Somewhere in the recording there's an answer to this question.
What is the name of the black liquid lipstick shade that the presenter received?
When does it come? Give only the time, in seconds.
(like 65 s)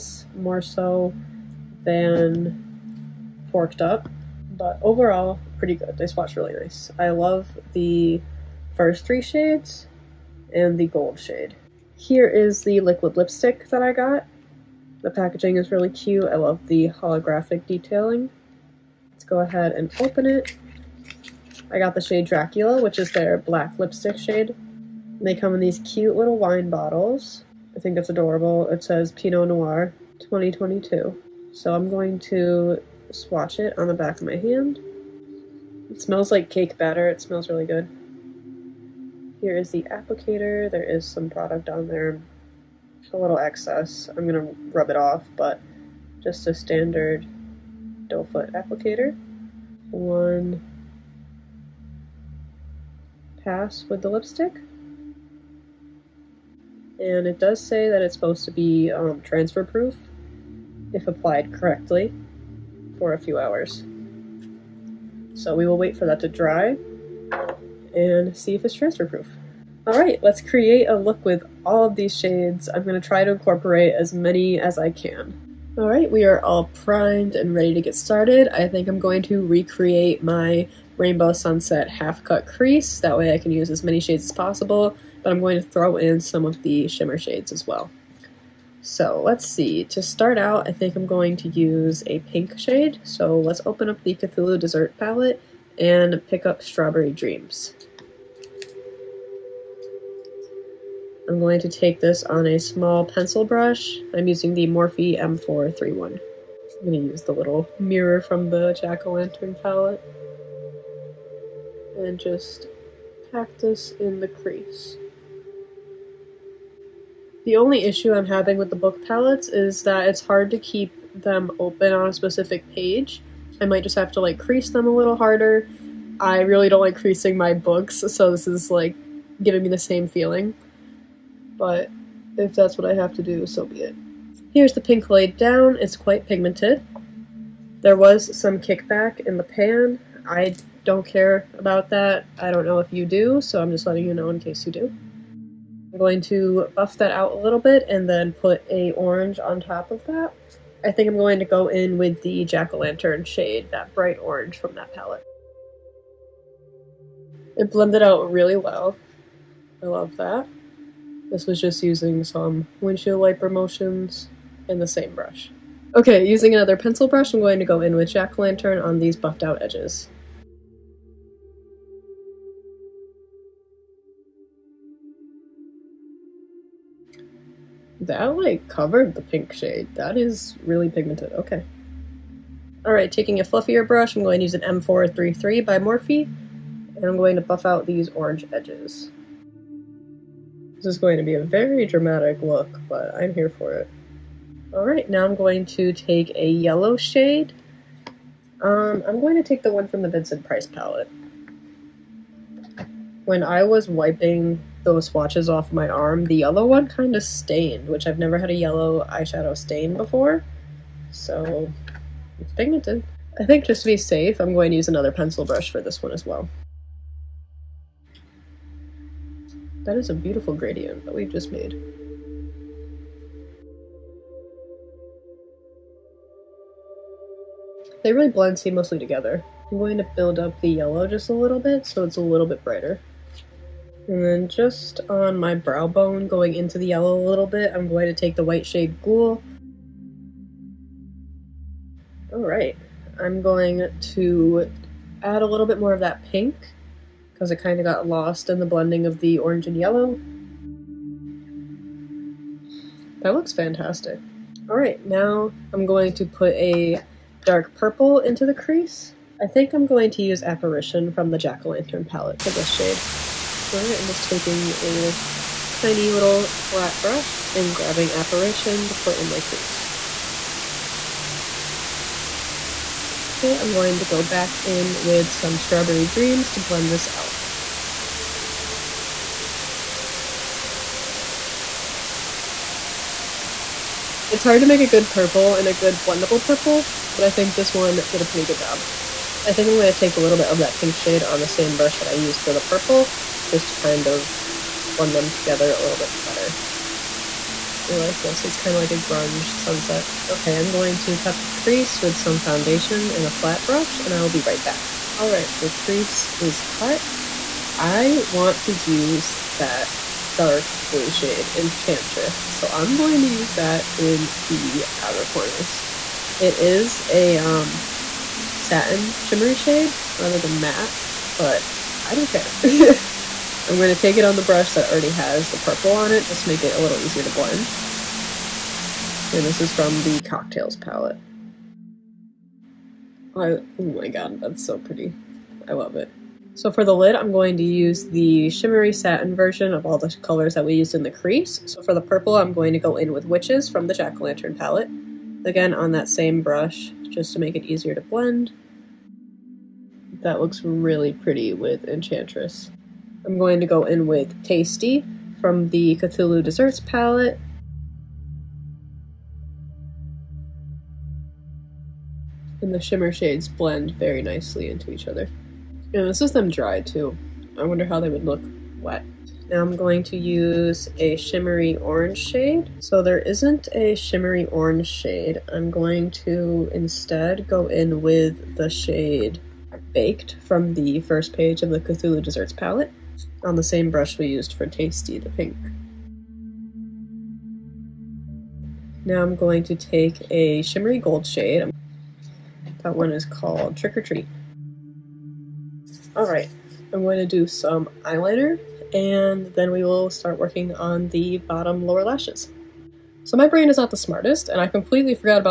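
22 s.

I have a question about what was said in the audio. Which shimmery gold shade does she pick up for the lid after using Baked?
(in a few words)
Trick or Treat.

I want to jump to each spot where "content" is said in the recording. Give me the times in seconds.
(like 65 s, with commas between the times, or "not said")
not said.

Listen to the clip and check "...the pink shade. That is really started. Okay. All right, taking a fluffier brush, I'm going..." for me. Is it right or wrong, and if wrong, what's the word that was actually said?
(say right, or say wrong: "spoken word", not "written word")
wrong: "pigmented", not "started".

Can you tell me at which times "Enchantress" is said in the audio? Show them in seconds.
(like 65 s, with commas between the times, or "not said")
311 s, 351 s.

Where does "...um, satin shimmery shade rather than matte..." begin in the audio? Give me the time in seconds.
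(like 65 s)
317 s.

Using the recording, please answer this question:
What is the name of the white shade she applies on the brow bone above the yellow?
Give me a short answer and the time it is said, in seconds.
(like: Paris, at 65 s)
Ghoul, at 239 s.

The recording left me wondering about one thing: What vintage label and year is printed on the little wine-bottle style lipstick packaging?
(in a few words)
Pinot Noir 2022.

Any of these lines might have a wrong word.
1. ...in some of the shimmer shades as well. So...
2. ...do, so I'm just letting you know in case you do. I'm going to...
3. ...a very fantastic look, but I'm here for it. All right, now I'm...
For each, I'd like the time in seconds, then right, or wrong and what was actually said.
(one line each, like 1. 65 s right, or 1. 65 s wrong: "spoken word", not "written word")
1. 85 s right
2. 143 s right
3. 191 s wrong: "dramatic", not "fantastic".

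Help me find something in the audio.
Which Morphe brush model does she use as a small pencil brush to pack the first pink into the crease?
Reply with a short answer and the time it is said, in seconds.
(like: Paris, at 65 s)
Morphe M431, at 104 s.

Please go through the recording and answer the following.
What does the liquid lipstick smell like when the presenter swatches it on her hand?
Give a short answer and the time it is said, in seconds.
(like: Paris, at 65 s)
Cake batter, at 36 s.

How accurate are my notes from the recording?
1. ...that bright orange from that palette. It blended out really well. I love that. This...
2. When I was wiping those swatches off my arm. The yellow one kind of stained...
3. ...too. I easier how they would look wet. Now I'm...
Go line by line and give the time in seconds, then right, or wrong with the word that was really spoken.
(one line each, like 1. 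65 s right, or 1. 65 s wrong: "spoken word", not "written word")
1. 153 s right
2. 203 s right
3. 366 s wrong: "wonder", not "easier".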